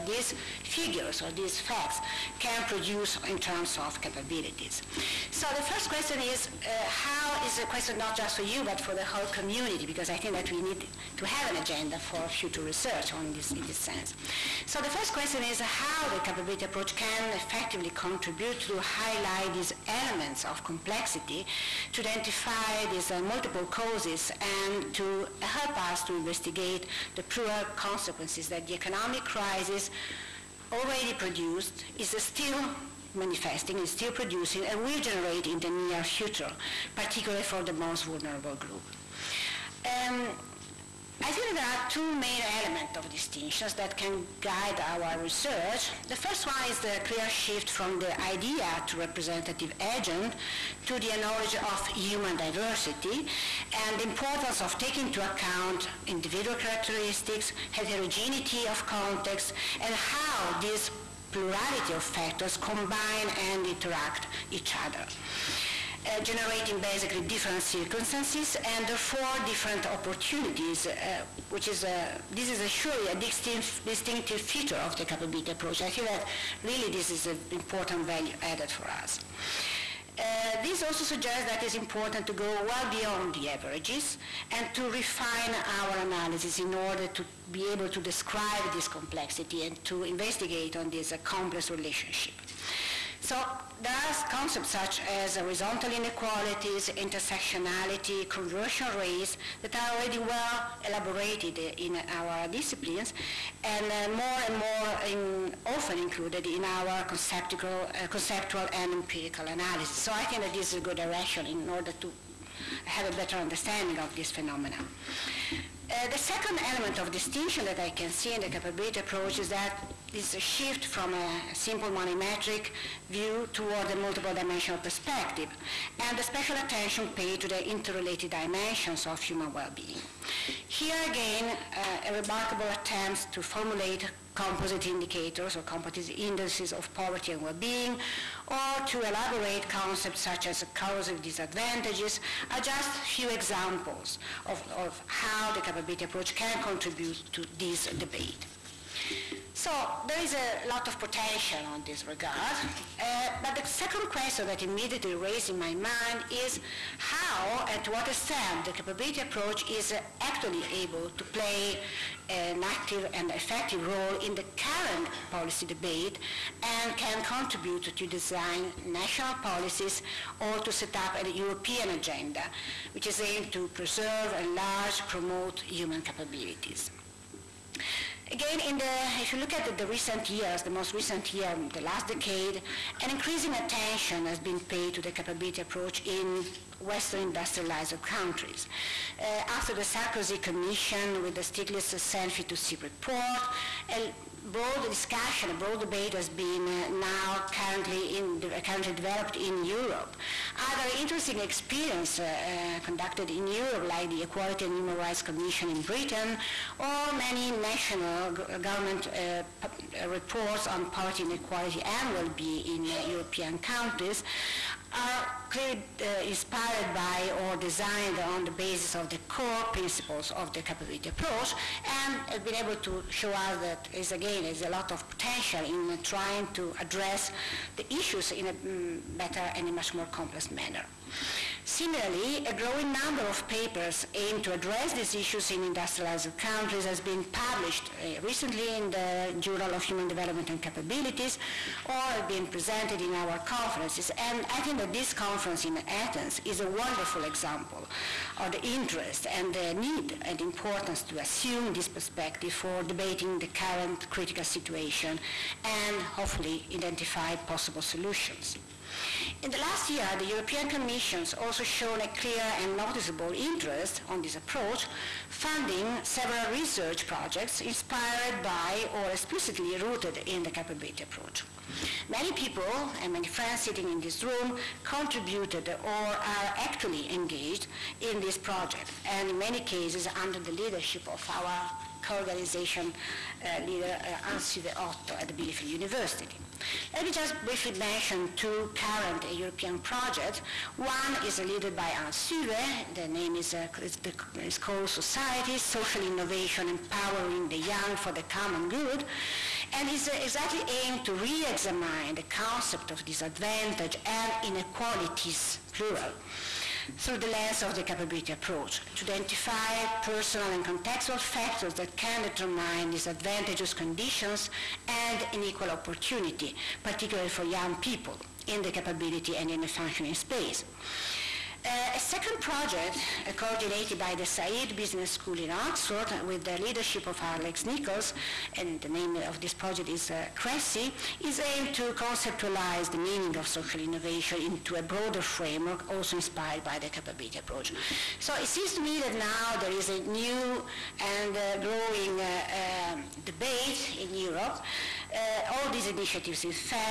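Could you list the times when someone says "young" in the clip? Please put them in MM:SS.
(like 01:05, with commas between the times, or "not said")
04:57, 05:17.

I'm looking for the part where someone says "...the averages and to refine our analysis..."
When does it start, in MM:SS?
01:23.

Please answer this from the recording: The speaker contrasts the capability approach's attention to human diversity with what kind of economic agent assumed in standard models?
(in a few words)
representative agent.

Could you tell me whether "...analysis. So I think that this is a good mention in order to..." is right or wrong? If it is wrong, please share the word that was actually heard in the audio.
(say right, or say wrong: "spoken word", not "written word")
wrong: "direction", not "mention".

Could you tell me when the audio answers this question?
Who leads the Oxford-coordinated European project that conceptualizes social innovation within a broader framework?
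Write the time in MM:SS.
05:27.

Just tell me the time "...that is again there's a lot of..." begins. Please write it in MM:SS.
03:43.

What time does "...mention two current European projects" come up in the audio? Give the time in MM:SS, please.
04:47.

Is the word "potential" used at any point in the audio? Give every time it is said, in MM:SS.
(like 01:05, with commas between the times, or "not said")
02:30, 03:45.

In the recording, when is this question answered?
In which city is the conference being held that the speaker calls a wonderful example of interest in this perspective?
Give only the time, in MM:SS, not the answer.
04:05.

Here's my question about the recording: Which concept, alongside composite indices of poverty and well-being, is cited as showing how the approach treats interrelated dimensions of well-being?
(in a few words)
corrosive disadvantages.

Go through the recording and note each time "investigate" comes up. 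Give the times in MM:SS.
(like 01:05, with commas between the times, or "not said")
00:26, 01:30.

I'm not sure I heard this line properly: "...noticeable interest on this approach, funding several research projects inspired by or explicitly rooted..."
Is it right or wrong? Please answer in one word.
right.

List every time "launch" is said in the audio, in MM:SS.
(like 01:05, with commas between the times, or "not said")
not said.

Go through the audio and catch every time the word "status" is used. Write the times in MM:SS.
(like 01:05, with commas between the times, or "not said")
not said.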